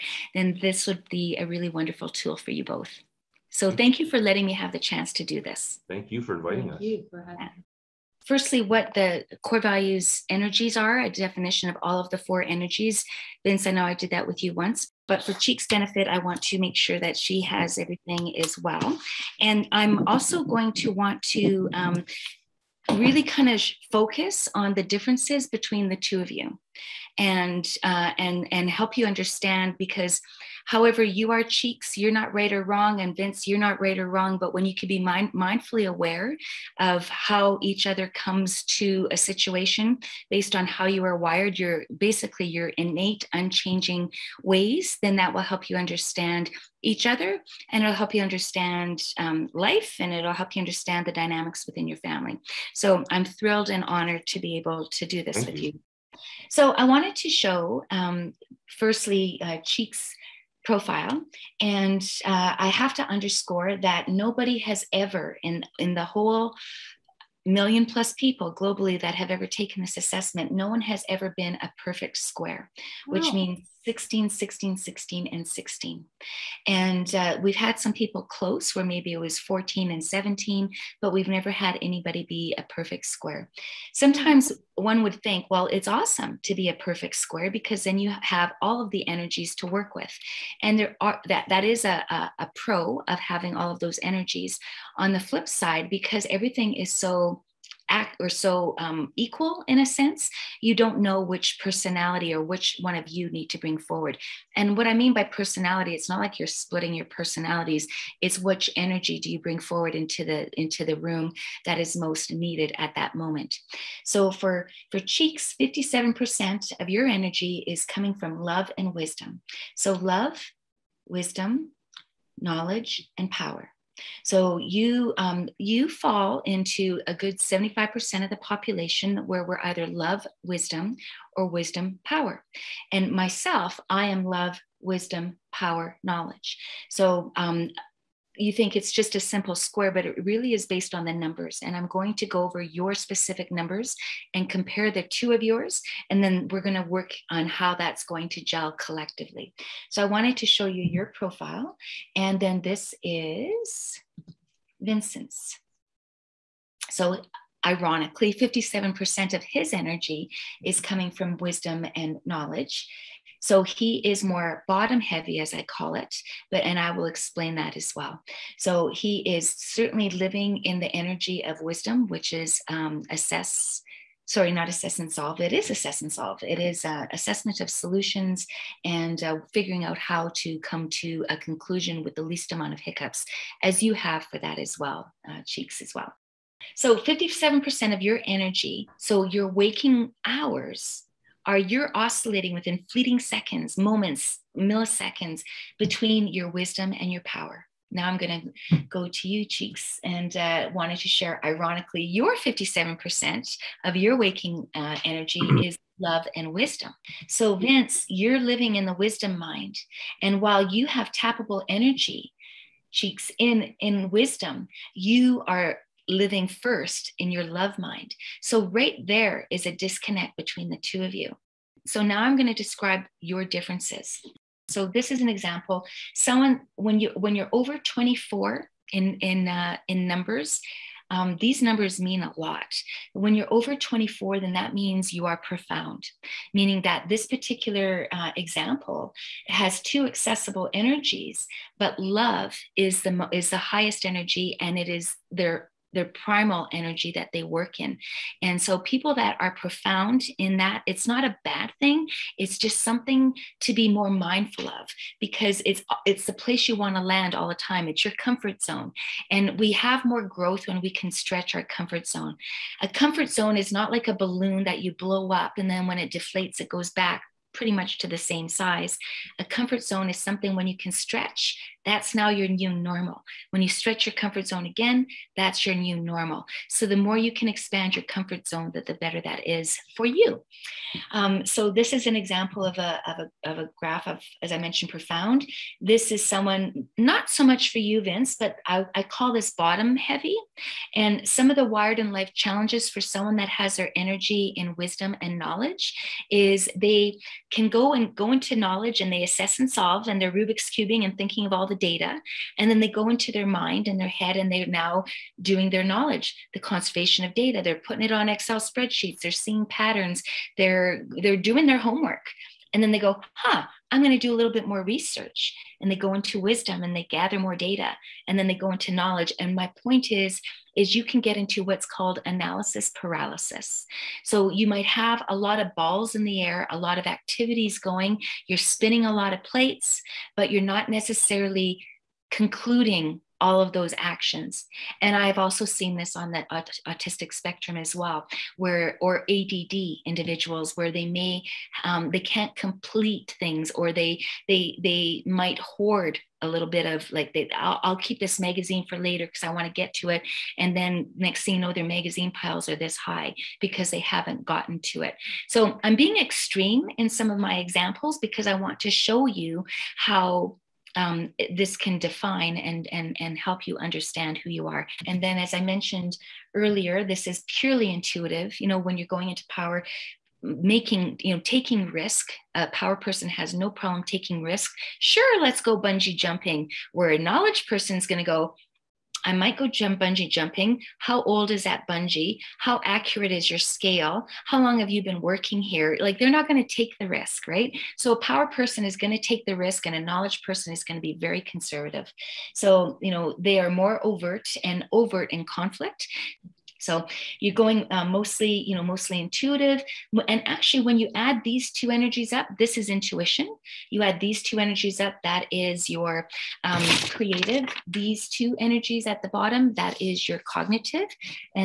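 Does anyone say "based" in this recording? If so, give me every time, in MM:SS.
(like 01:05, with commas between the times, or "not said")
00:40, 02:20.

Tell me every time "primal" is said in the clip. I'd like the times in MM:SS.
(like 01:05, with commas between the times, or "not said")
04:06.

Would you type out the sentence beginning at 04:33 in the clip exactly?
When you stretch your comfort zone again, that's your new normal.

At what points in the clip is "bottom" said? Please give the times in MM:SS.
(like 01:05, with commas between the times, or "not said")
02:44, 04:49, 06:49.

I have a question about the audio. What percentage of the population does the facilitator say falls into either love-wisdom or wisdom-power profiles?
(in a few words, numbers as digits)
75%.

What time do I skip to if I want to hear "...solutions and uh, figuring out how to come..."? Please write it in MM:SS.
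02:57.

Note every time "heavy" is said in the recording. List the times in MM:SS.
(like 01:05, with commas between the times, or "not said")
02:44, 04:49.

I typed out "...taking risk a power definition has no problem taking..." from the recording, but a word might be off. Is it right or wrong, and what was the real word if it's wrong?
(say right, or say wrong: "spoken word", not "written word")
wrong: "person", not "definition".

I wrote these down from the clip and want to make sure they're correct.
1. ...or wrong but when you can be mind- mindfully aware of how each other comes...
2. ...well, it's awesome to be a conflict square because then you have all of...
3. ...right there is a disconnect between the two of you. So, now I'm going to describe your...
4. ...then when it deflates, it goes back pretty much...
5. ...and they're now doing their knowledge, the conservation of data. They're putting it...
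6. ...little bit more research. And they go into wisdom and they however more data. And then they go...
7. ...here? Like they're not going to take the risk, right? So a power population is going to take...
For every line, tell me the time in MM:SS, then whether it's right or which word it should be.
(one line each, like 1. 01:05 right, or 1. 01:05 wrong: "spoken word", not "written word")
1. 00:33 right
2. 01:25 wrong: "perfect", not "conflict"
3. 03:38 right
4. 04:25 right
5. 05:04 right
6. 05:14 wrong: "gather", not "however"
7. 06:25 wrong: "person", not "population".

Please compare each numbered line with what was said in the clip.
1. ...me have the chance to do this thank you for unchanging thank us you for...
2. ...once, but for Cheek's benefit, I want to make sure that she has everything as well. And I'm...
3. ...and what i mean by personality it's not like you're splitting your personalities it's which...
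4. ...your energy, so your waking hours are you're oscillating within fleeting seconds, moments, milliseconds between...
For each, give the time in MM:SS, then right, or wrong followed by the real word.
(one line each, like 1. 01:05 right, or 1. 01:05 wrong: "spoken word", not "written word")
1. 00:04 wrong: "inviting", not "unchanging"
2. 00:14 right
3. 01:44 right
4. 03:08 right.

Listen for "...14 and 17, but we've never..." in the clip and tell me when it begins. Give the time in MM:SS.
01:19.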